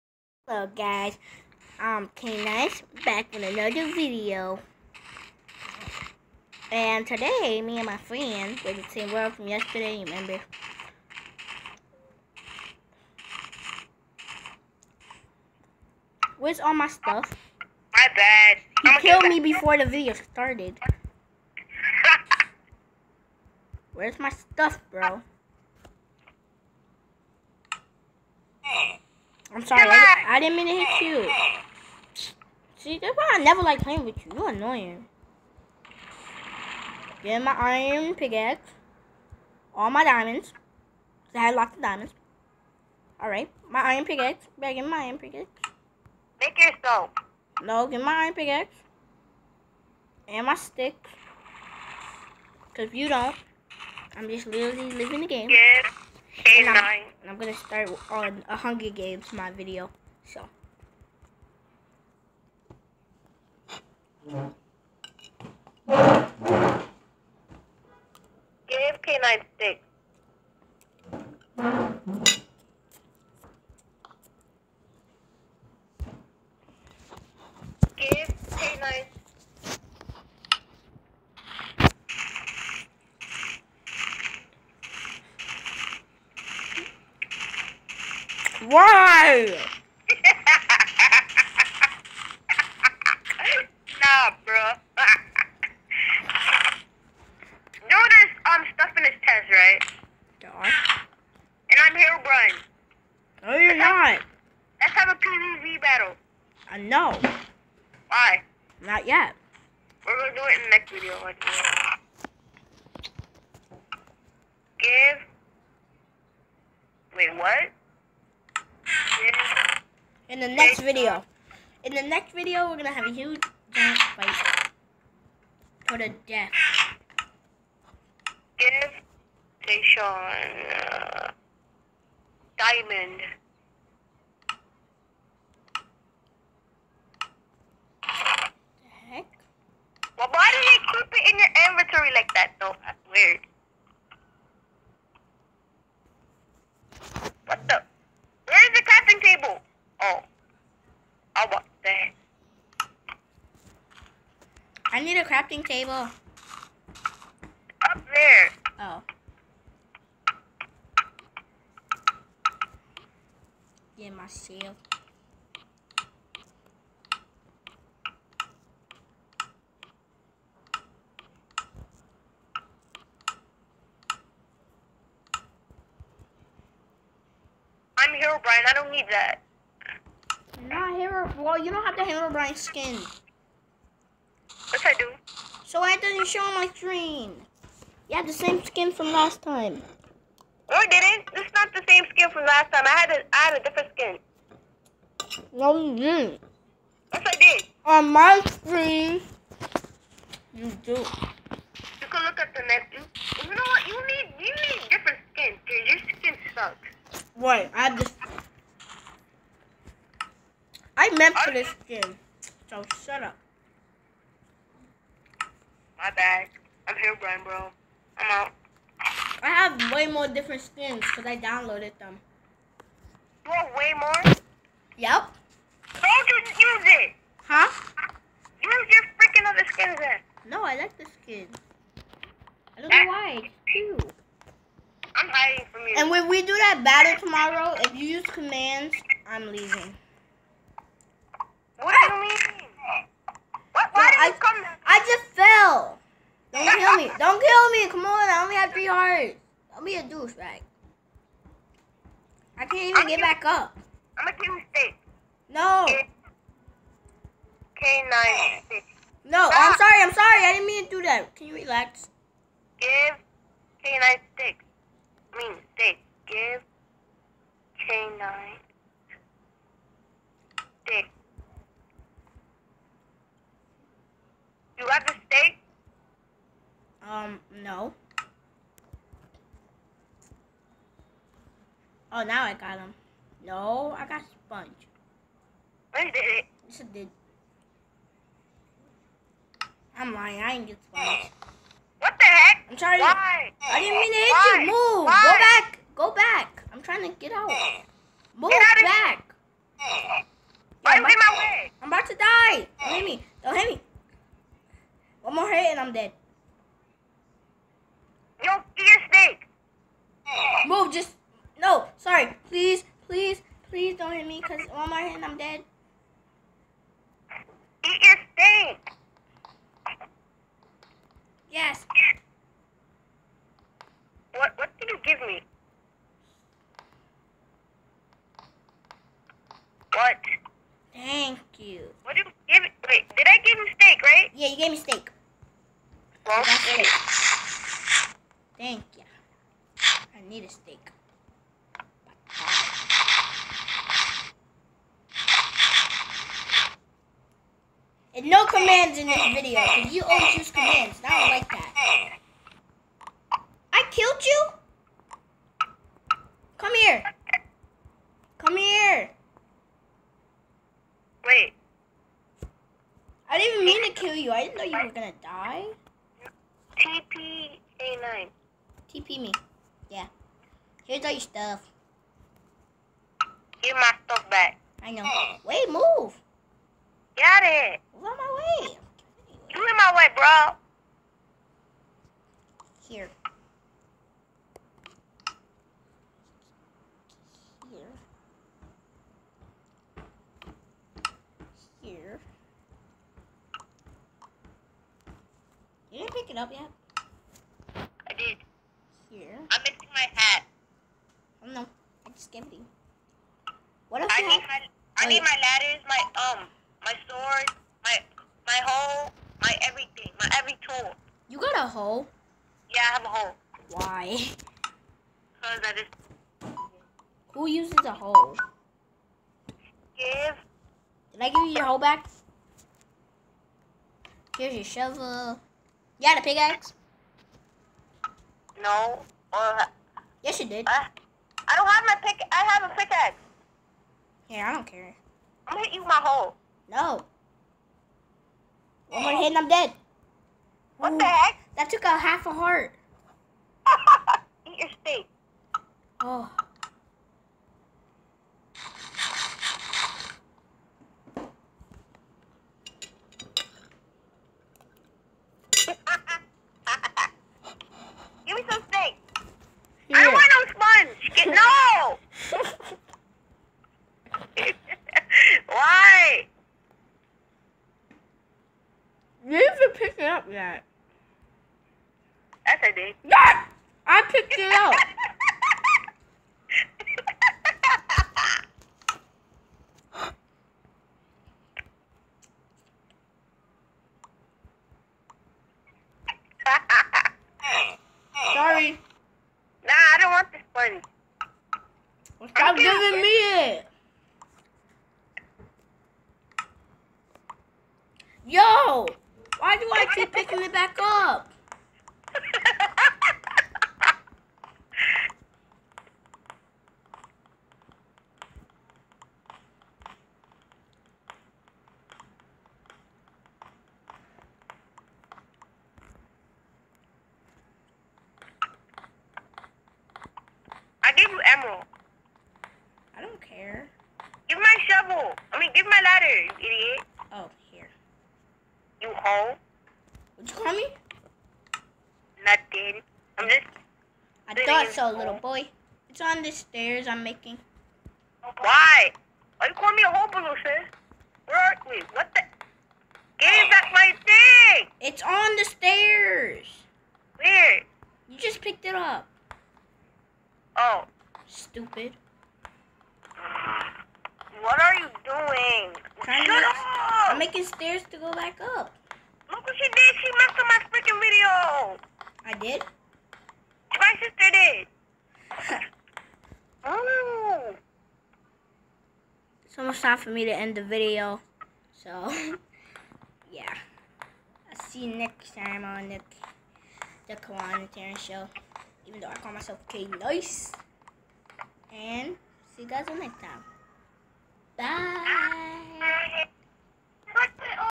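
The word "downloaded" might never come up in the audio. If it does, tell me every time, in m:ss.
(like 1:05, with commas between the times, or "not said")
3:41.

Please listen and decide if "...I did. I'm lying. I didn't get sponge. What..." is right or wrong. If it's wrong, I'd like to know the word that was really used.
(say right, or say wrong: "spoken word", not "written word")
right.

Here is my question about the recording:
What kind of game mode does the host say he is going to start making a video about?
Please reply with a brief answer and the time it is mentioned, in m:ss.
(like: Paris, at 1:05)
Hunger Games, at 0:58.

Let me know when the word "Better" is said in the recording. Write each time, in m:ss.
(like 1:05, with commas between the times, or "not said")
0:44.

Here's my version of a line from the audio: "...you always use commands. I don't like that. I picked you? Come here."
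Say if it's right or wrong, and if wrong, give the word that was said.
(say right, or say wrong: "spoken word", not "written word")
wrong: "killed", not "picked".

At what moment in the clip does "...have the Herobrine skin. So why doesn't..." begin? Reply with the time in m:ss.
3:01.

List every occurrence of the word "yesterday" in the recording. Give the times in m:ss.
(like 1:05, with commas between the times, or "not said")
0:09.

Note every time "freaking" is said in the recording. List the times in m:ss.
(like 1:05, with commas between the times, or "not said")
3:49, 9:20.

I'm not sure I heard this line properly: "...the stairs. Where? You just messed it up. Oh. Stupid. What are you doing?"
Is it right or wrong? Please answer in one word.
wrong.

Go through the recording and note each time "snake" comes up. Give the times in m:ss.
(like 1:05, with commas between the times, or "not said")
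5:09, 5:18.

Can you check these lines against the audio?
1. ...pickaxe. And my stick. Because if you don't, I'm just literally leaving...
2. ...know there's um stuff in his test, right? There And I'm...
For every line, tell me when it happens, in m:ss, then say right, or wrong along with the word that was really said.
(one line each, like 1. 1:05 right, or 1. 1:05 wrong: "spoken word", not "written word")
1. 0:48 right
2. 1:37 right.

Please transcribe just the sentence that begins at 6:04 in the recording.
I didn't know you were going to die.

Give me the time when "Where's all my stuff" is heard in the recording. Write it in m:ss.
0:16.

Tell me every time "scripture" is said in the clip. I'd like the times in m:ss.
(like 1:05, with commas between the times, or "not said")
not said.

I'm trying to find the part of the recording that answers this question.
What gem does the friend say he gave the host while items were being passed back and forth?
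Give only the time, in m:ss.
8:41.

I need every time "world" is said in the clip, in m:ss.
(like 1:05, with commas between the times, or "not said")
0:09.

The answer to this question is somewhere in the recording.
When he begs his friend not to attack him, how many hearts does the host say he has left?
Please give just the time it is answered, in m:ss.
4:08.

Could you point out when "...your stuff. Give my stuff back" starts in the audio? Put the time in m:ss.
6:11.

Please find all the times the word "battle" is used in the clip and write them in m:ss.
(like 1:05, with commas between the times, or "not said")
1:45, 3:56.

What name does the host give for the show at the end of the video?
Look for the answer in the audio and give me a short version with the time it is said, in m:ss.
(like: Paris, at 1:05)
The Kawaun and Terrence show, at 9:37.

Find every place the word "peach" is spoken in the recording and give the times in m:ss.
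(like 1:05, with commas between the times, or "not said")
not said.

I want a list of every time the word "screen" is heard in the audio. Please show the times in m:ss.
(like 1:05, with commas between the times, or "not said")
3:06, 3:18.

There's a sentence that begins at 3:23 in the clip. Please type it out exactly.
You need you need different skin.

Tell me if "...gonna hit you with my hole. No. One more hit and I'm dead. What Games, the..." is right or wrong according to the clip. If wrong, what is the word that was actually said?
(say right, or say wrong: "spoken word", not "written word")
wrong: "Ooh", not "Games".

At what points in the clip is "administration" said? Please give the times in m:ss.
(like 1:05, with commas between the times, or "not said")
not said.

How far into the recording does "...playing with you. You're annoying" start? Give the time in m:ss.
0:33.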